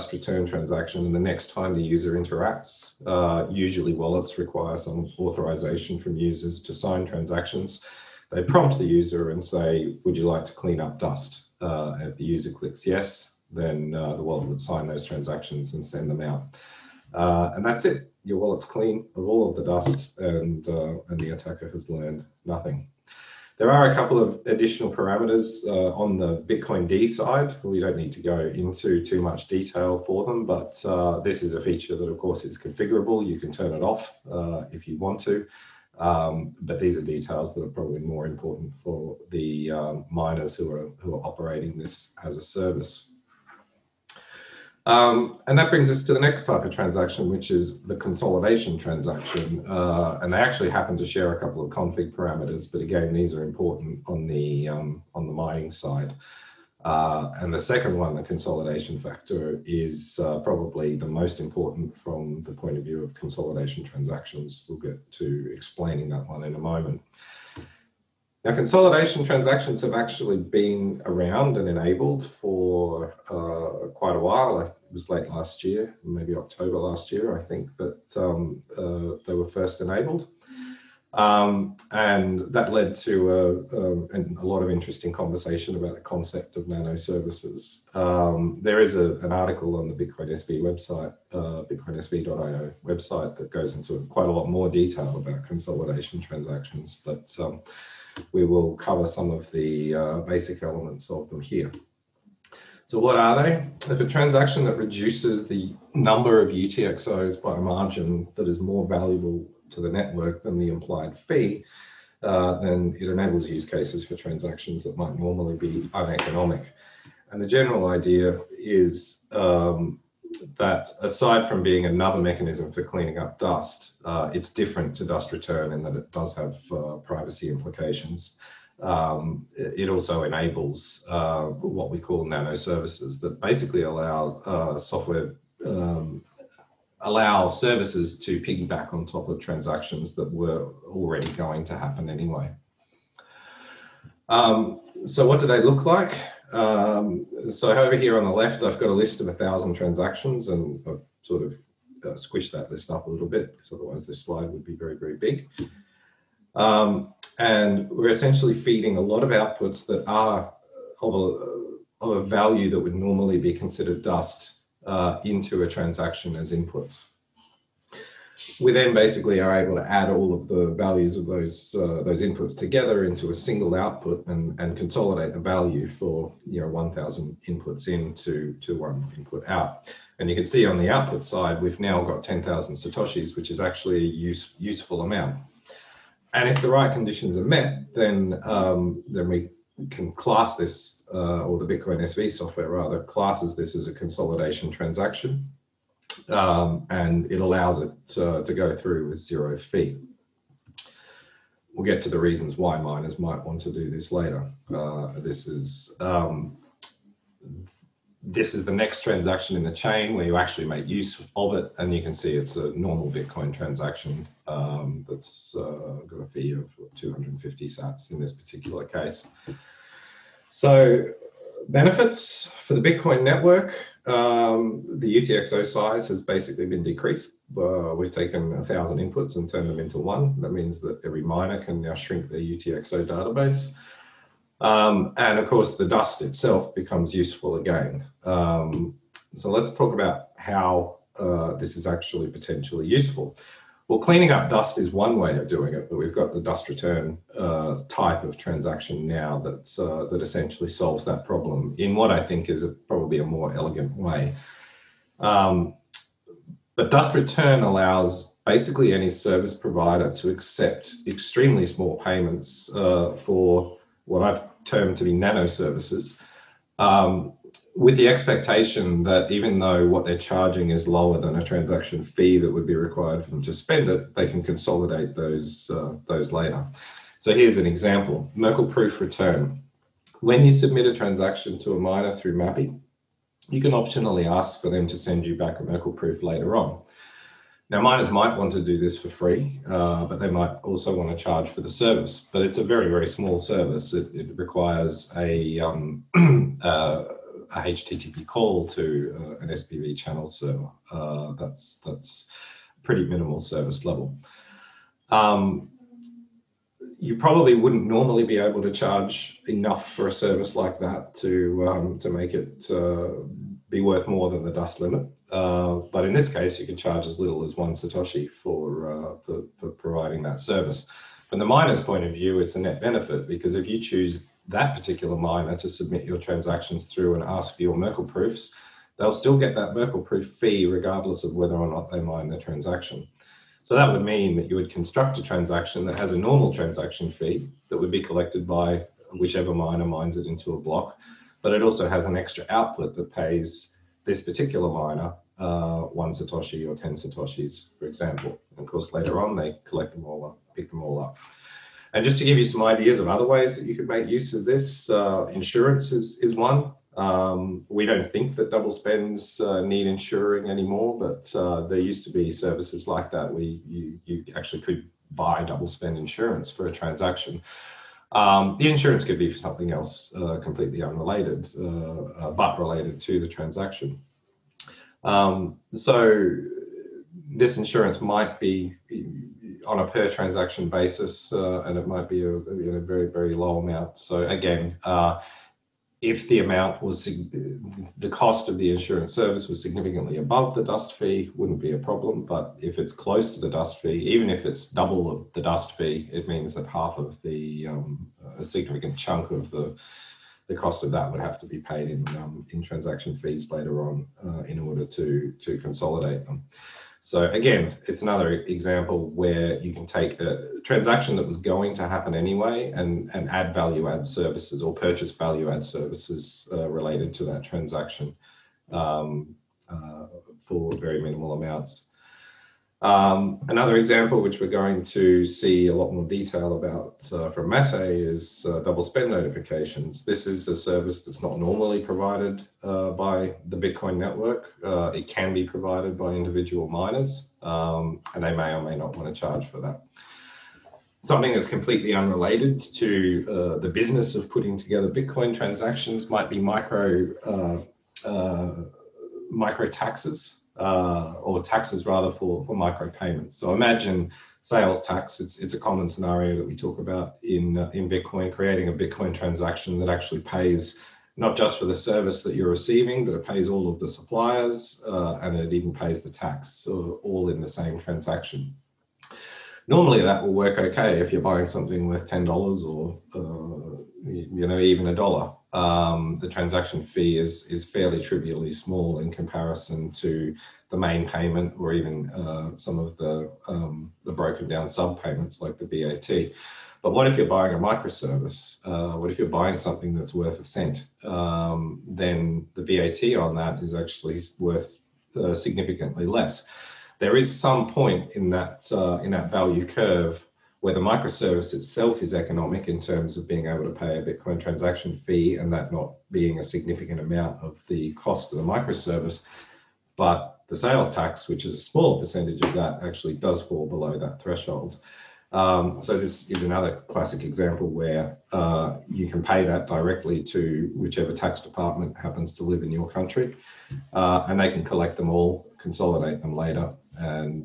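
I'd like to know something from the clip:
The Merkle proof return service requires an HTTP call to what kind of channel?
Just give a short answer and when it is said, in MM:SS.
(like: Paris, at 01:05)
SPV channel, at 04:59.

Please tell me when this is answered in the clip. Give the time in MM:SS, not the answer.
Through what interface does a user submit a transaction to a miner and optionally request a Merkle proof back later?
04:42.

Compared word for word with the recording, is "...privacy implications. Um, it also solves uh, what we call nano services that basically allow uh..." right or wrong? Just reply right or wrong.
wrong.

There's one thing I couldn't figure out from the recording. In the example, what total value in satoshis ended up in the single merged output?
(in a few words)
10000 satoshis.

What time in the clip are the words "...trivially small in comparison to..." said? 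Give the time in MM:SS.
07:58.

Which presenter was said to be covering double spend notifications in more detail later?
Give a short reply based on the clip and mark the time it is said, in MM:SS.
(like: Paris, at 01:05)
Matej, at 07:07.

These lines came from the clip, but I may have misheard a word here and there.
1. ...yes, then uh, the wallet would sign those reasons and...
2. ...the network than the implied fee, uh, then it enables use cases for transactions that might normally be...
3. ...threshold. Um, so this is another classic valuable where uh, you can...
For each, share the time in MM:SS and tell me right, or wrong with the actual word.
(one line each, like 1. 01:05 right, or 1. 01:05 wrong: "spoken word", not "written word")
1. 00:12 wrong: "transactions", not "reasons"
2. 01:49 right
3. 08:34 wrong: "example", not "valuable".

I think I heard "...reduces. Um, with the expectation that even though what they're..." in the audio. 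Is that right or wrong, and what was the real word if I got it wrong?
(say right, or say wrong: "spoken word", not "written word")
wrong: "services", not "reduces".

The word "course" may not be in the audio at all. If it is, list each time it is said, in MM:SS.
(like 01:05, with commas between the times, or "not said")
00:32, 03:55, 05:48.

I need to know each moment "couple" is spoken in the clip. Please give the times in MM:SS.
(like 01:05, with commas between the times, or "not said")
00:23, 00:51.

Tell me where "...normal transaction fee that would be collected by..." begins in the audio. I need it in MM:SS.
05:36.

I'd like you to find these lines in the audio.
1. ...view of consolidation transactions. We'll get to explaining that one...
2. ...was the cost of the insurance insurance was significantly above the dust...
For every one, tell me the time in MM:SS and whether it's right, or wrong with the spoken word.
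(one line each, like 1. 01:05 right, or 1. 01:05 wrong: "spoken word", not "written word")
1. 01:02 right
2. 06:26 wrong: "service", not "insurance".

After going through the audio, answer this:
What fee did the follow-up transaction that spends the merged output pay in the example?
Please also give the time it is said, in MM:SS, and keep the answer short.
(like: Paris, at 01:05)
250 Sats, at 03:36.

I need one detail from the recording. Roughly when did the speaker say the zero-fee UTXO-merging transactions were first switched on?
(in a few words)
October last year.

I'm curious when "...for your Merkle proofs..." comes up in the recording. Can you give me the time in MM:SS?
05:27.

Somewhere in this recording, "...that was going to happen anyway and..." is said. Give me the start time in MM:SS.
06:51.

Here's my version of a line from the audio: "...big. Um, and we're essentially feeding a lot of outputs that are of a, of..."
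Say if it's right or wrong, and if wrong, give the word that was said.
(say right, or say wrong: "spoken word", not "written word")
right.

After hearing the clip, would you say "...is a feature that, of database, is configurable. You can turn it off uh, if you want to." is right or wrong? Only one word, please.
wrong.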